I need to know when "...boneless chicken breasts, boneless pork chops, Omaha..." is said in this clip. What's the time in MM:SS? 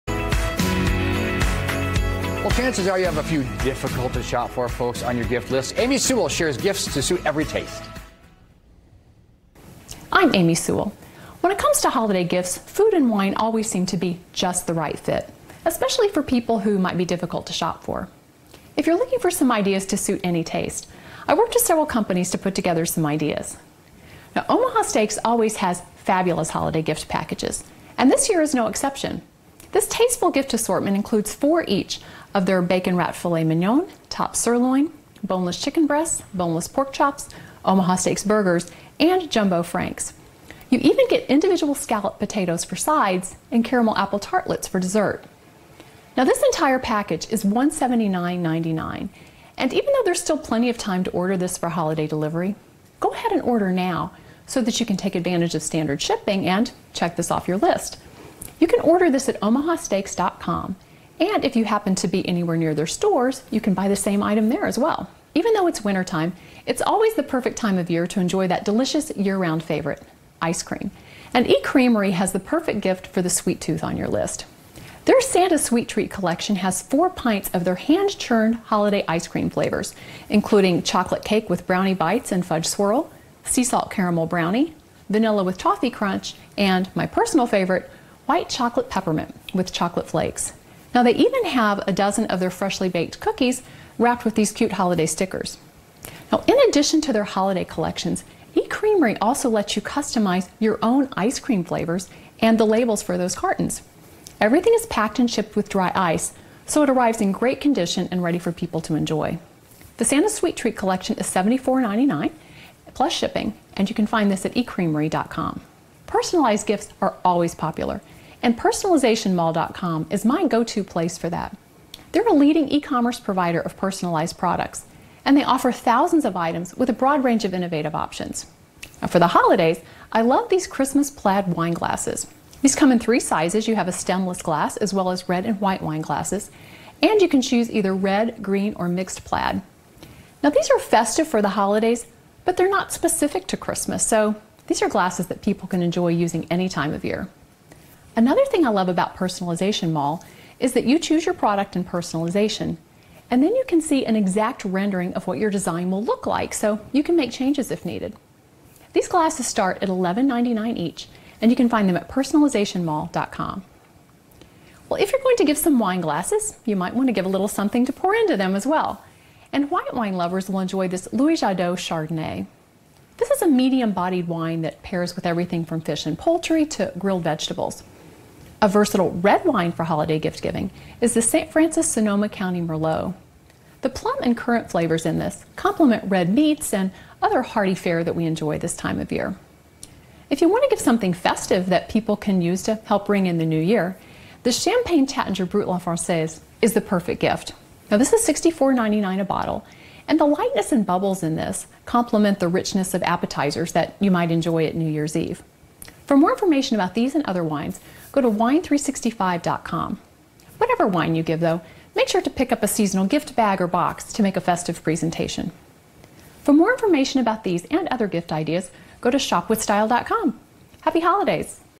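00:35.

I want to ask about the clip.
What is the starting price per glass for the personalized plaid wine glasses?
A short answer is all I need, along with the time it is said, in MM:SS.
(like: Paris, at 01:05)
$11.99, at 02:39.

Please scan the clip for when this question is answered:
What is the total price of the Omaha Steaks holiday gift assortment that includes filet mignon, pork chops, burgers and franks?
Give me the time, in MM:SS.
00:47.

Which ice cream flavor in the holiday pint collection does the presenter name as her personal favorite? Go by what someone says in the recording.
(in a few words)
White chocolate peppermint with chocolate flakes.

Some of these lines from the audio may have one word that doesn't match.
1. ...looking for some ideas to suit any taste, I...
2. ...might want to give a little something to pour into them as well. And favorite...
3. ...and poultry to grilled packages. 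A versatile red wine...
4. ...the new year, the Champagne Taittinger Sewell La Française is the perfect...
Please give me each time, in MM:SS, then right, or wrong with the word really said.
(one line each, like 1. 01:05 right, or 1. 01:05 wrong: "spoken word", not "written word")
1. 00:18 right
2. 02:46 wrong: "white", not "favorite"
3. 02:56 wrong: "vegetables", not "packages"
4. 03:13 wrong: "Brut", not "Sewell".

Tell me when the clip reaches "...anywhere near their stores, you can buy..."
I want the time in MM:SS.
01:02.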